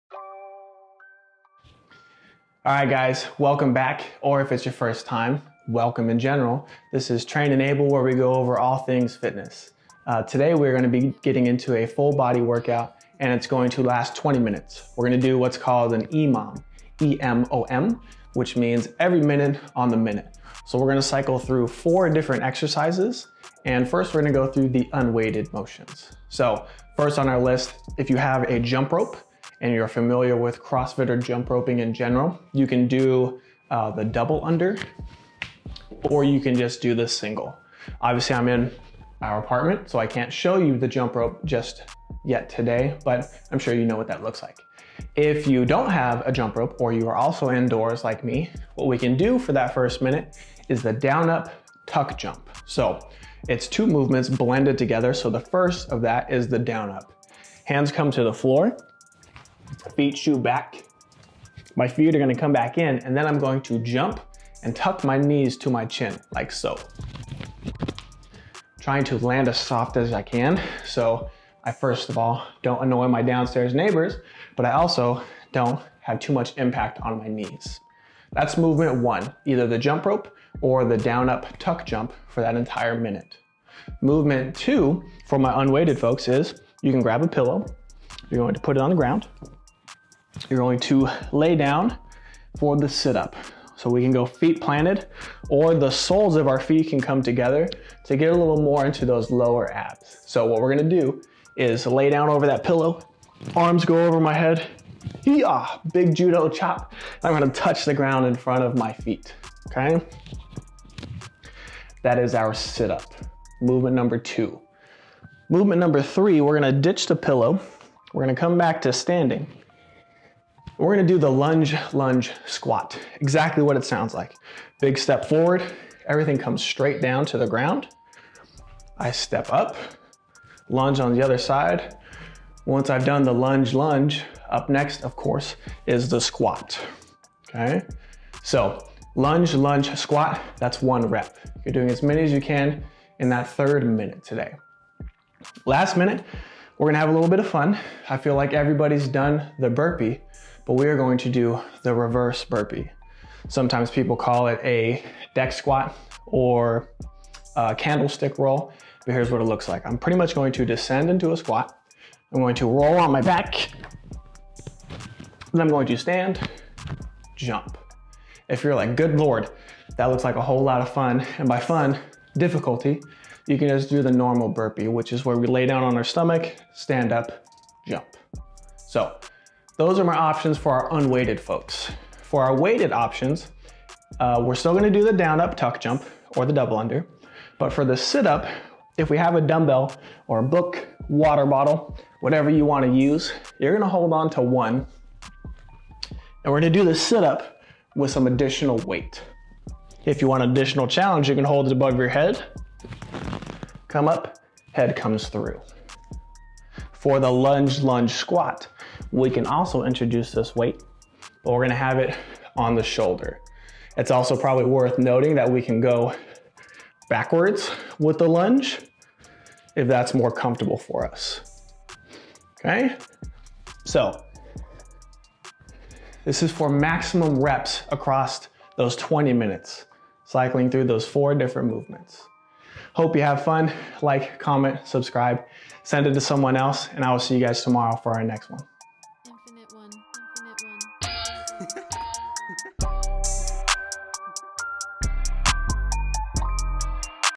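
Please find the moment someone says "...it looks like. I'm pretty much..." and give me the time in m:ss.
2:39.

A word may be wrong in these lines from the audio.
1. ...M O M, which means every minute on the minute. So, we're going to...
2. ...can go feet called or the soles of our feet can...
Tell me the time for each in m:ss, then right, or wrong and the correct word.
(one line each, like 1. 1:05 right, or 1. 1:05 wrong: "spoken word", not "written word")
1. 0:17 right
2. 1:34 wrong: "planted", not "called".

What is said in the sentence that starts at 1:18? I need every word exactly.
That's movement one, either the jump rope or the down up tuck jump for that entire minute.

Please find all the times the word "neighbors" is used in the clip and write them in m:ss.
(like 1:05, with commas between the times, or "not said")
1:13.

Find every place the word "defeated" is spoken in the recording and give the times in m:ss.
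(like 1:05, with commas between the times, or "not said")
not said.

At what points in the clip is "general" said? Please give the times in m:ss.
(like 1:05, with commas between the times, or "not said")
0:06, 0:31.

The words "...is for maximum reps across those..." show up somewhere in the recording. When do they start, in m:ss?
3:46.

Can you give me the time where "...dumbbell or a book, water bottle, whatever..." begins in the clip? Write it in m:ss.
3:09.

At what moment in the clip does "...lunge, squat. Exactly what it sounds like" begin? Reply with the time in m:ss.
2:01.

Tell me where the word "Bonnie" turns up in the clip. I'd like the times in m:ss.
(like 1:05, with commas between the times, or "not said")
not said.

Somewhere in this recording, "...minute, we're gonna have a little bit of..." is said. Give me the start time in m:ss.
2:25.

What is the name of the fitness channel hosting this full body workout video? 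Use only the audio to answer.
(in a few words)
Train And Able.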